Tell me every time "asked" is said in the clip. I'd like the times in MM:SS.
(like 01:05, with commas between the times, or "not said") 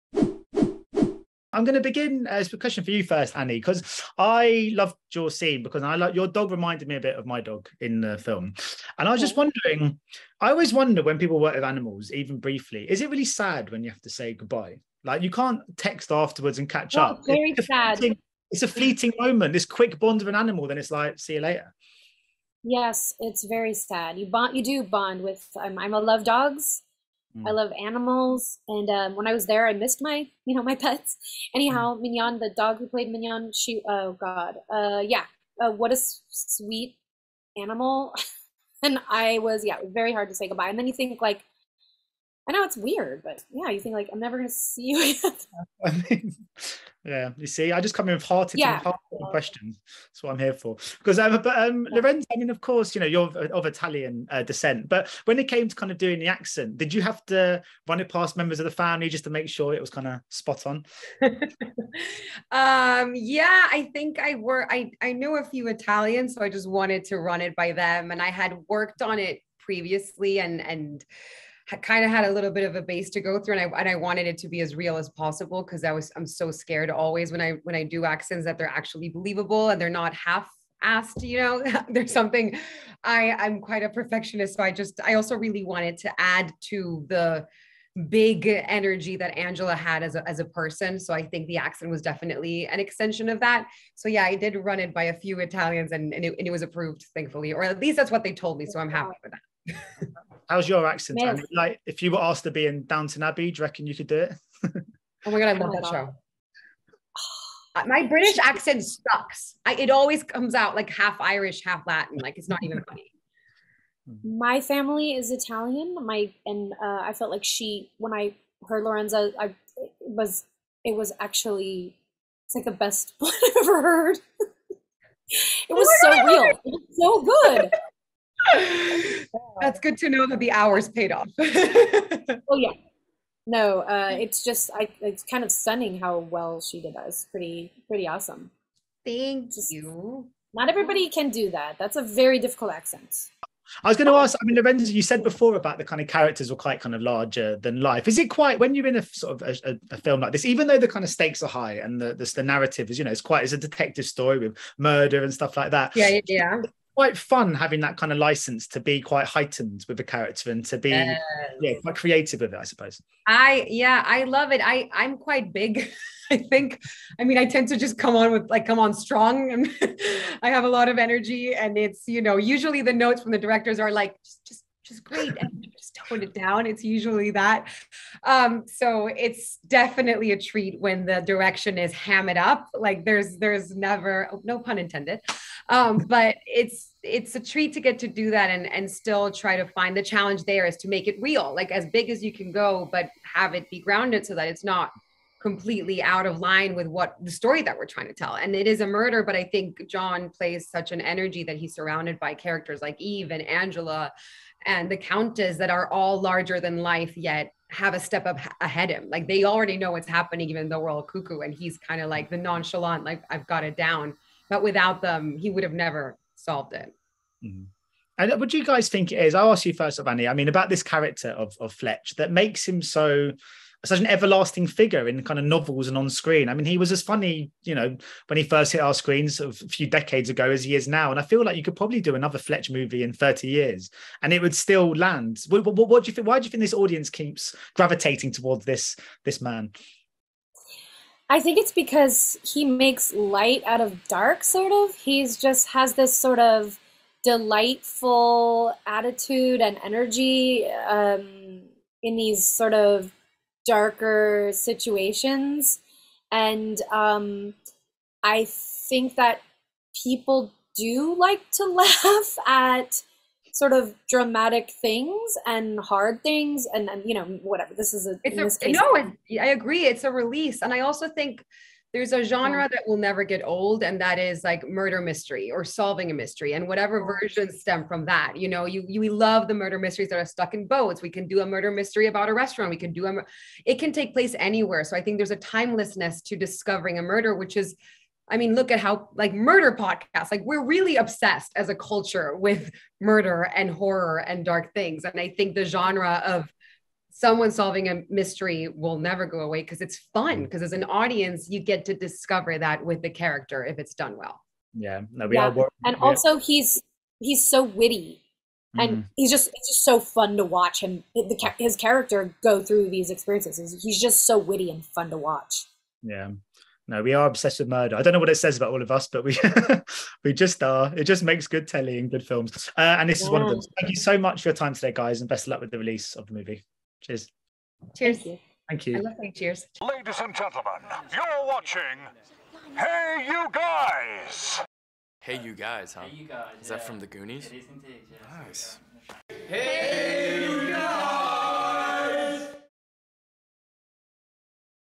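01:20, 01:42.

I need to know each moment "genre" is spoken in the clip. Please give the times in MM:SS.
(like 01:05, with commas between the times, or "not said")
04:32, 04:55.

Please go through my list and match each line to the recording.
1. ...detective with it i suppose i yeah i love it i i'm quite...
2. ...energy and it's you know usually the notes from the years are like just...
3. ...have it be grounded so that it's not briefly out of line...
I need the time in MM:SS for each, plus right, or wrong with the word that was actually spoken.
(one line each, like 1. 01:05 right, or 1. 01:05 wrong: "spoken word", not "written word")
1. 02:41 wrong: "creative", not "detective"
2. 02:50 wrong: "directors", not "years"
3. 03:13 wrong: "completely", not "briefly".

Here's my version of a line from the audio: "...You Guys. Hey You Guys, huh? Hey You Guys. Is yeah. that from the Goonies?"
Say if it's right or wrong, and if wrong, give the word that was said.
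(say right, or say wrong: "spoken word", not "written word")
right.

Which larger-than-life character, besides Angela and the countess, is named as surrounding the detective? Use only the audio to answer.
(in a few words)
Eve.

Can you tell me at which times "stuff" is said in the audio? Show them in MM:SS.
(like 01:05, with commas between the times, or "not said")
02:35.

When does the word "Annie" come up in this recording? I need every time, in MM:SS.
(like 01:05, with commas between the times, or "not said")
00:03, 03:40.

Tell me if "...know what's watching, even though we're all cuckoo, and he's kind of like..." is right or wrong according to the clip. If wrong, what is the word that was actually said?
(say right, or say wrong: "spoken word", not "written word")
wrong: "happening", not "watching".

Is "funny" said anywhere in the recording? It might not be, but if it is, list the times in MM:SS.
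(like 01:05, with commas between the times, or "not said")
01:52, 03:47.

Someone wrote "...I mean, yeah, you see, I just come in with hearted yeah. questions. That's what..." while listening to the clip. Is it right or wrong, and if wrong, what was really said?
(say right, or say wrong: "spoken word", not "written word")
right.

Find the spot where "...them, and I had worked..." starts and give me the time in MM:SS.
01:07.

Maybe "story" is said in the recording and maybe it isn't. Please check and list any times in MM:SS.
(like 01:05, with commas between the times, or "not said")
02:34, 03:17.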